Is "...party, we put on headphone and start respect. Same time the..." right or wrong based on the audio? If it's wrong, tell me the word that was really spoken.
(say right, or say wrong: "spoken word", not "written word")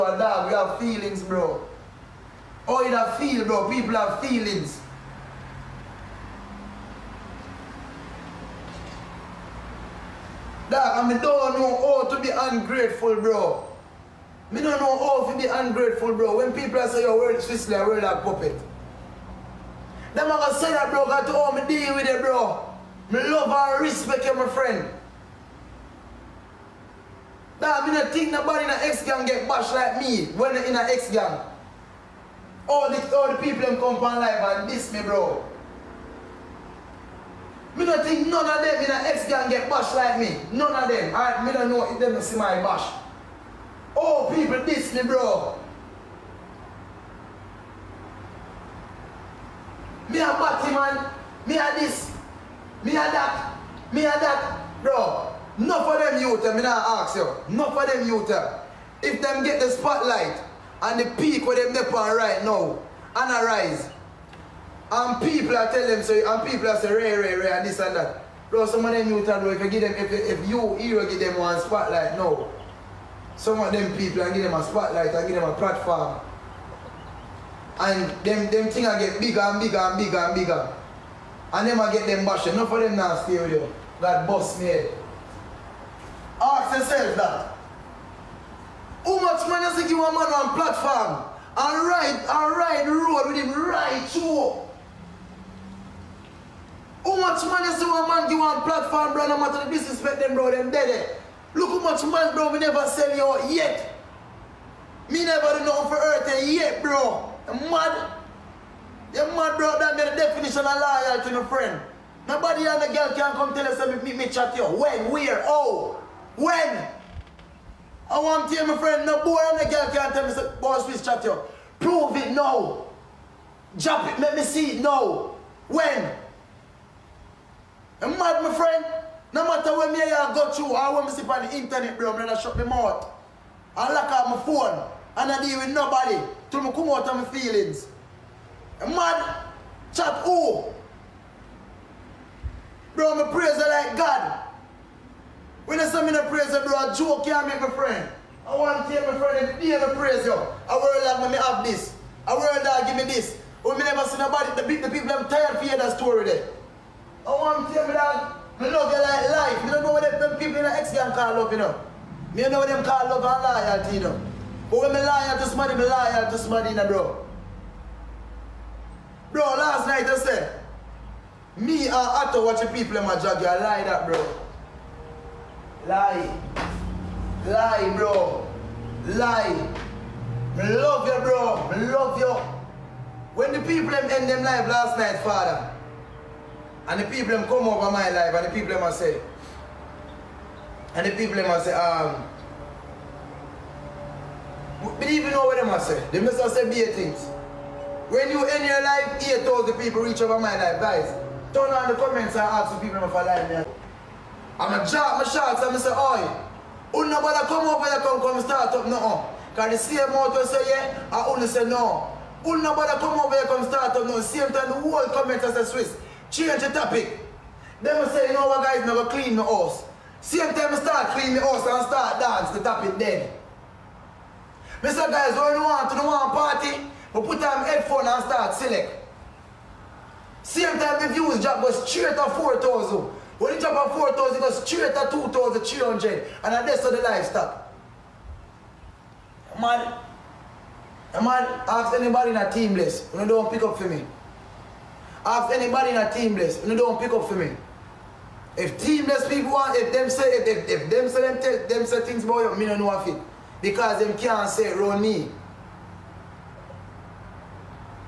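wrong: "select", not "respect".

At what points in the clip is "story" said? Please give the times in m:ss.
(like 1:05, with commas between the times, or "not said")
2:35.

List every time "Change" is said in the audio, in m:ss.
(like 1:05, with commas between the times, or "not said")
3:36.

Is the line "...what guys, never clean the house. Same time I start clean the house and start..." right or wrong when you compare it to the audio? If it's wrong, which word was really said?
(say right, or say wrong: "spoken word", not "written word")
right.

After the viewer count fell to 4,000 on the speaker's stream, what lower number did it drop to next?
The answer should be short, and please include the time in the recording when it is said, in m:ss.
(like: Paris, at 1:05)
2,300, at 3:55.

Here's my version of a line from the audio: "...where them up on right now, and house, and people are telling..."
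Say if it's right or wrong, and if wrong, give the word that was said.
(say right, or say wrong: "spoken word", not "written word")
wrong: "arise", not "house".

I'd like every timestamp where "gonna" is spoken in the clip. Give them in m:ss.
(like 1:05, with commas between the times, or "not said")
0:20, 2:12.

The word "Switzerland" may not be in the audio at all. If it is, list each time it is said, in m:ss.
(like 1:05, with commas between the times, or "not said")
0:17.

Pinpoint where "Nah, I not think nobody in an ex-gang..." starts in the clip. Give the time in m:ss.
0:27.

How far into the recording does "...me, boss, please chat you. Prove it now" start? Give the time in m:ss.
2:00.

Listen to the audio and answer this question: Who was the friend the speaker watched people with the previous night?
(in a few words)
Otto.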